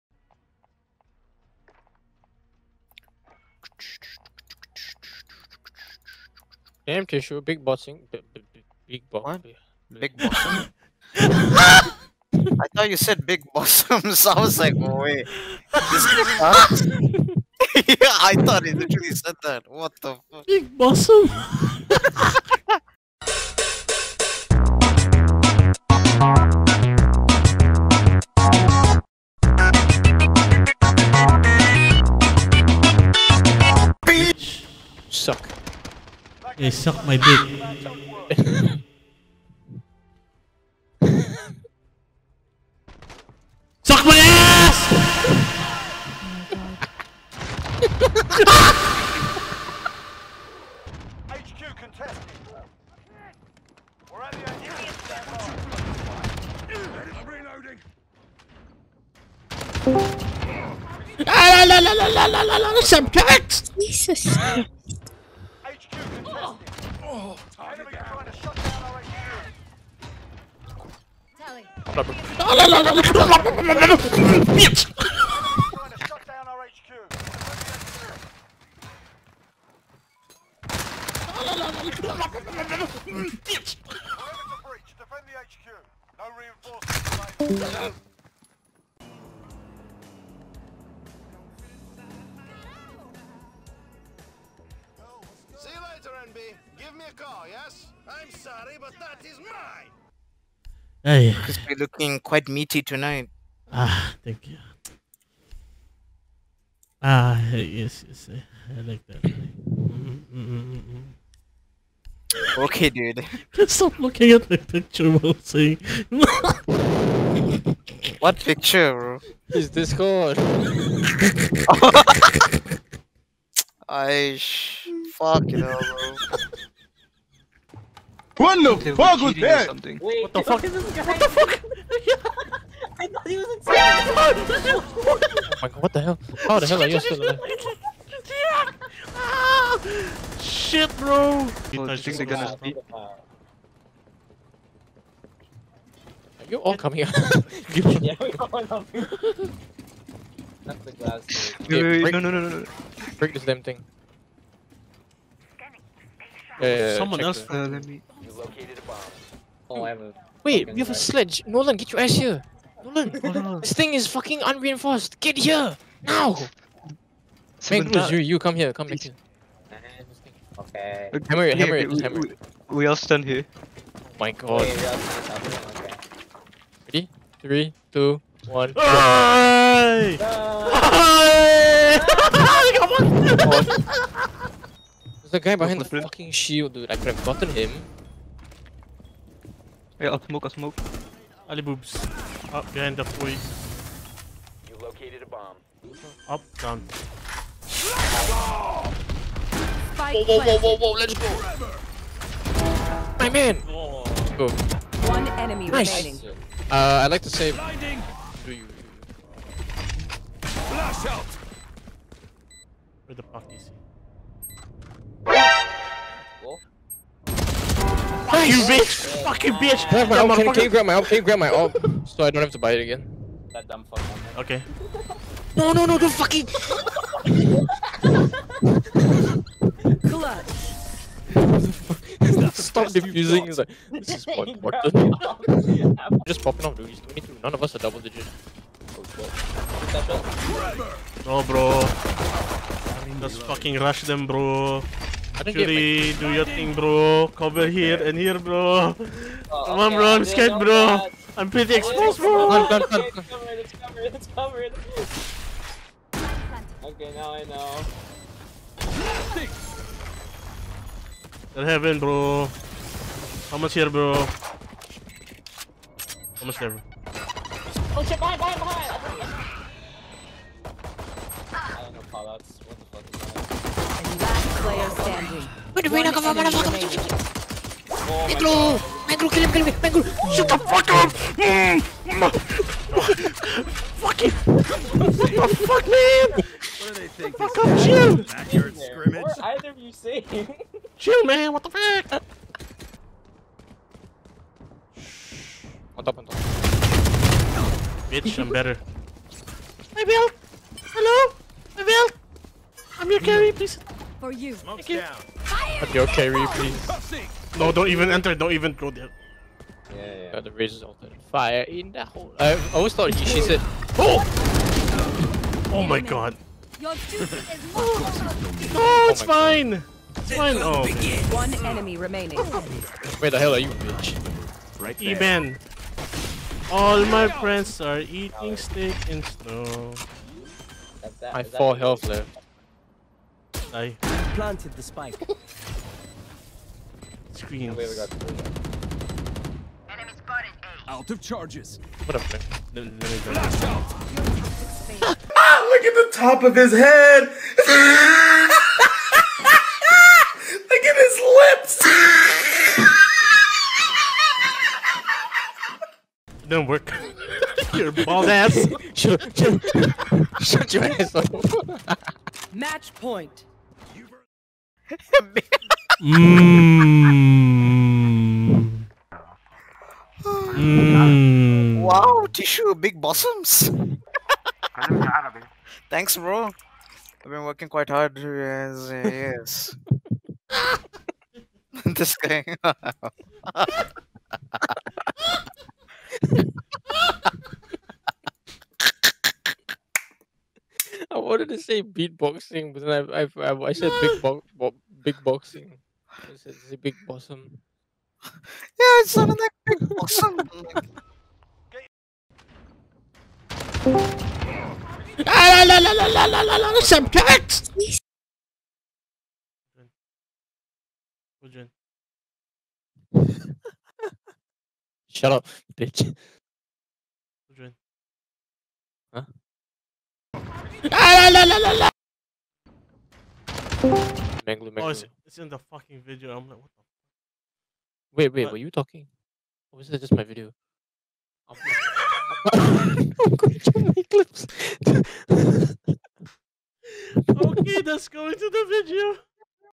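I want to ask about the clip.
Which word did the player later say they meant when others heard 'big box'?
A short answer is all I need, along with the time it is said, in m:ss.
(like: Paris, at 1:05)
beatboxing, at 6:31.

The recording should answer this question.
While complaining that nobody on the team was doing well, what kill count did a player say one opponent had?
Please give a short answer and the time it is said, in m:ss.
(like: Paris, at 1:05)
22, at 3:56.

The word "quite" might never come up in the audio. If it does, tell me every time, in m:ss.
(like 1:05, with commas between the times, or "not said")
1:42, 6:17.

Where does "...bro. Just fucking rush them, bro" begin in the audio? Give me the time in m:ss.
4:01.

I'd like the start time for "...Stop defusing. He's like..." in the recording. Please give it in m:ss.
3:52.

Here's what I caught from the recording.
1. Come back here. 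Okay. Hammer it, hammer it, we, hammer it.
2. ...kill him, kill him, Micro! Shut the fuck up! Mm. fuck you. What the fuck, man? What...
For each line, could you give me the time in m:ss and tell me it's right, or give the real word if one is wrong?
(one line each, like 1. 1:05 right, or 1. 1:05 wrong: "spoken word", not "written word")
1. 2:48 right
2. 4:39 right.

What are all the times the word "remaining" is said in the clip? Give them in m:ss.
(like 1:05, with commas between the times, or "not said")
3:26, 5:21.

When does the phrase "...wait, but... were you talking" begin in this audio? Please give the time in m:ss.
7:08.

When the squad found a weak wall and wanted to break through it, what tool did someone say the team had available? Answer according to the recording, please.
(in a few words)
sledge.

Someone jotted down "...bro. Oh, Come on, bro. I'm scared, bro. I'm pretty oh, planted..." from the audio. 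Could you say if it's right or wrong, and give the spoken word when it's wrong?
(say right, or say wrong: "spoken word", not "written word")
wrong: "exposed", not "planted".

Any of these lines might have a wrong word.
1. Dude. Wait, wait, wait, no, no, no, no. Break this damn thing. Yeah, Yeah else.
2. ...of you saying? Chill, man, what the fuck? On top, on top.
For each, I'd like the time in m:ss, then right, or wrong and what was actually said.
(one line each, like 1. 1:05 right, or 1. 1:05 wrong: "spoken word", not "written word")
1. 2:31 wrong: "Someone", not "Yeah"
2. 4:49 right.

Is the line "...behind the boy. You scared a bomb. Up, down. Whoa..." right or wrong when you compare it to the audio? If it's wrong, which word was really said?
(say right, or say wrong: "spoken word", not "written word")
wrong: "located", not "scared".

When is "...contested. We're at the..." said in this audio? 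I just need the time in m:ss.
0:51.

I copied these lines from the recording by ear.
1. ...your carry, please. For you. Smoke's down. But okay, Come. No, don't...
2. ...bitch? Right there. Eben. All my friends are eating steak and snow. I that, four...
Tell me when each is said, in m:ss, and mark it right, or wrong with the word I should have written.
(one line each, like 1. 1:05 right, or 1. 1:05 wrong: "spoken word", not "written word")
1. 5:03 wrong: "Reapy", not "Come"
2. 5:23 right.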